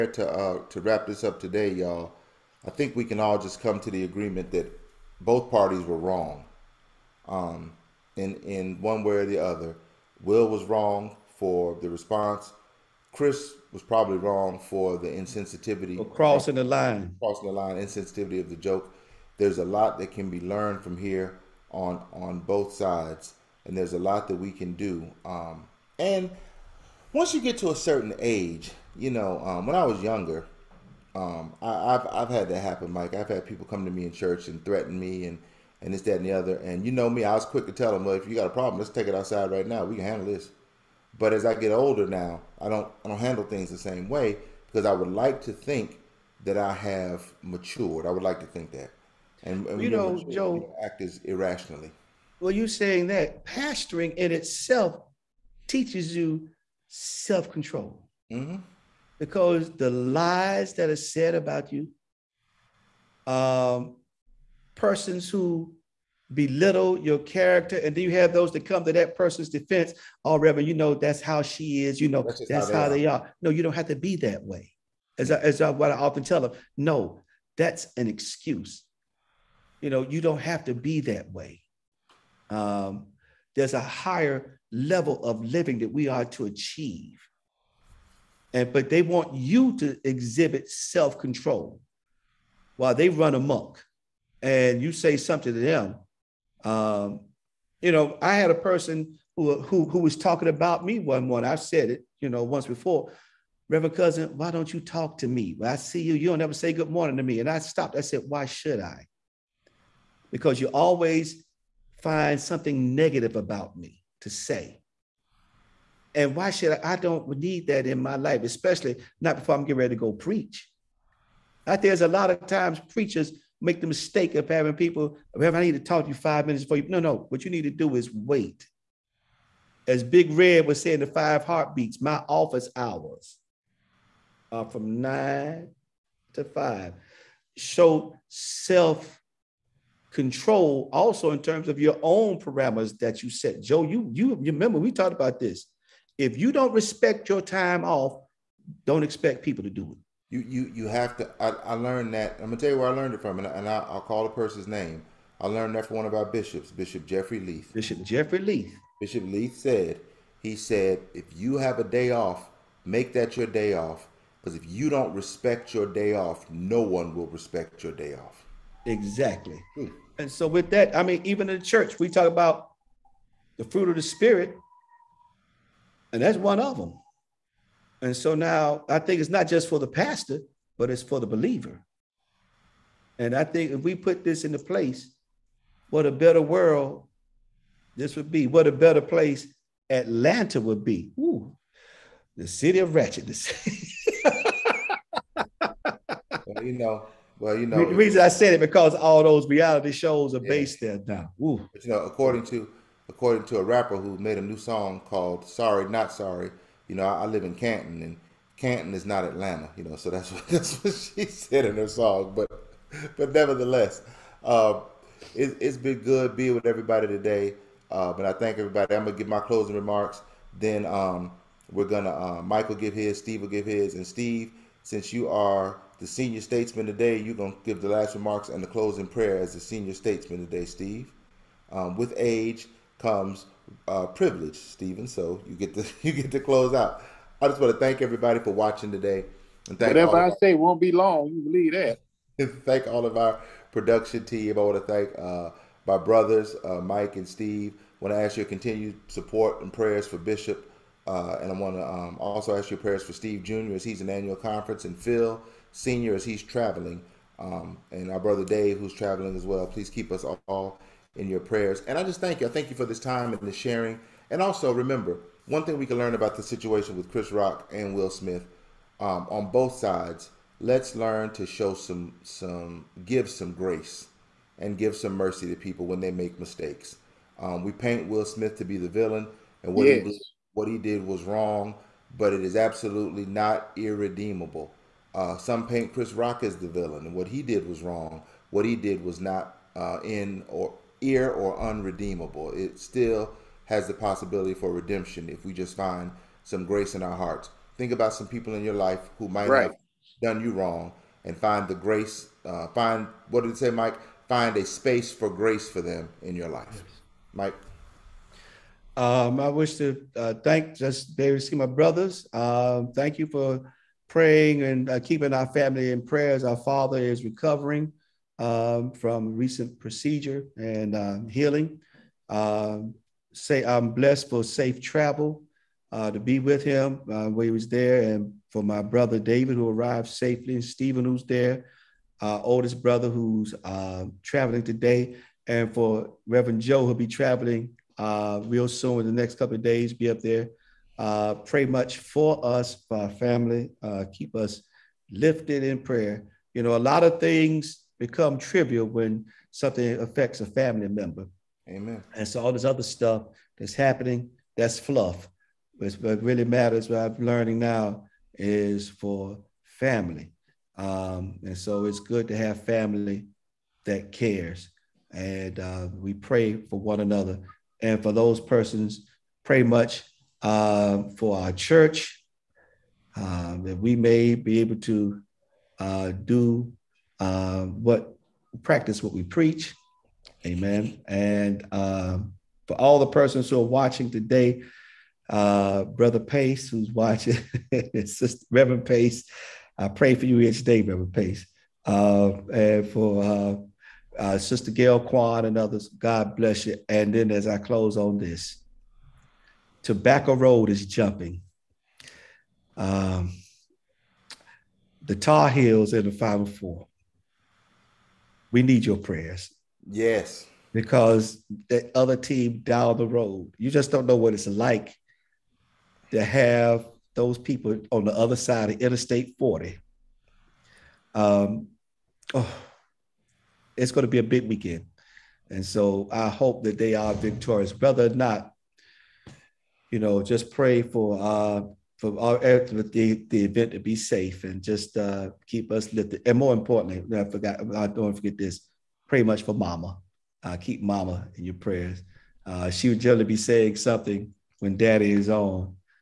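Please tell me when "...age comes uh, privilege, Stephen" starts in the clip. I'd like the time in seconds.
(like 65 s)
232 s.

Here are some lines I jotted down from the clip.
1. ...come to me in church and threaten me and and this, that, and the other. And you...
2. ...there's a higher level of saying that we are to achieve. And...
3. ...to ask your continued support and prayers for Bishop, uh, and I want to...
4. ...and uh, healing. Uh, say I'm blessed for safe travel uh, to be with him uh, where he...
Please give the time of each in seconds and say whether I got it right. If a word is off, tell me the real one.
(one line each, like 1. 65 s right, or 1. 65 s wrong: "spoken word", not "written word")
1. 33 s right
2. 83 s wrong: "living", not "saying"
3. 248 s right
4. 320 s right.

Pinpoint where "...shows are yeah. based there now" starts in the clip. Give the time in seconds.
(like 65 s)
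199 s.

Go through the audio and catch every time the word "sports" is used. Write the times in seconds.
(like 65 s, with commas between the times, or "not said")
not said.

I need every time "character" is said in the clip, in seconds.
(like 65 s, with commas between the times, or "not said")
67 s.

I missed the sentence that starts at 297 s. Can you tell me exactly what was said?
Think about some people in your life who might right.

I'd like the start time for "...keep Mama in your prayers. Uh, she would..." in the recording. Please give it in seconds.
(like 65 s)
440 s.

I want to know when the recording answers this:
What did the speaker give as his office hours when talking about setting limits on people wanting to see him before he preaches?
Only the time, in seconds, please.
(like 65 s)
135 s.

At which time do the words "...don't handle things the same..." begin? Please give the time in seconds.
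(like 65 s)
43 s.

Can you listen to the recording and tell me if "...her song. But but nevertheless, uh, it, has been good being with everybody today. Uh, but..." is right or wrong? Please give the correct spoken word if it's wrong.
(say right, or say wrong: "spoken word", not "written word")
right.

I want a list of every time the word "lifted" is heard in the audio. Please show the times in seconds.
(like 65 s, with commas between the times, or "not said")
345 s, 435 s.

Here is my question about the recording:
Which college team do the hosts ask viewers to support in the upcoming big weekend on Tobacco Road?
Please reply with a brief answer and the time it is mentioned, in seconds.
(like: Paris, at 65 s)
Tar Heels, at 405 s.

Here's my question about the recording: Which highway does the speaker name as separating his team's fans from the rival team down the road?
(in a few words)
Interstate 40.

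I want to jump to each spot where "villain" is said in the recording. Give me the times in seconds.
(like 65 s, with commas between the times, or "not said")
278 s, 286 s.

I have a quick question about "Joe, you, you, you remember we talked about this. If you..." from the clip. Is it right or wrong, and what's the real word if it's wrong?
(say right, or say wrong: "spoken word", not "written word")
right.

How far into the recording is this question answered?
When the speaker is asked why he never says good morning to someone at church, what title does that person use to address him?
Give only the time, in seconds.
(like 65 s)
103 s.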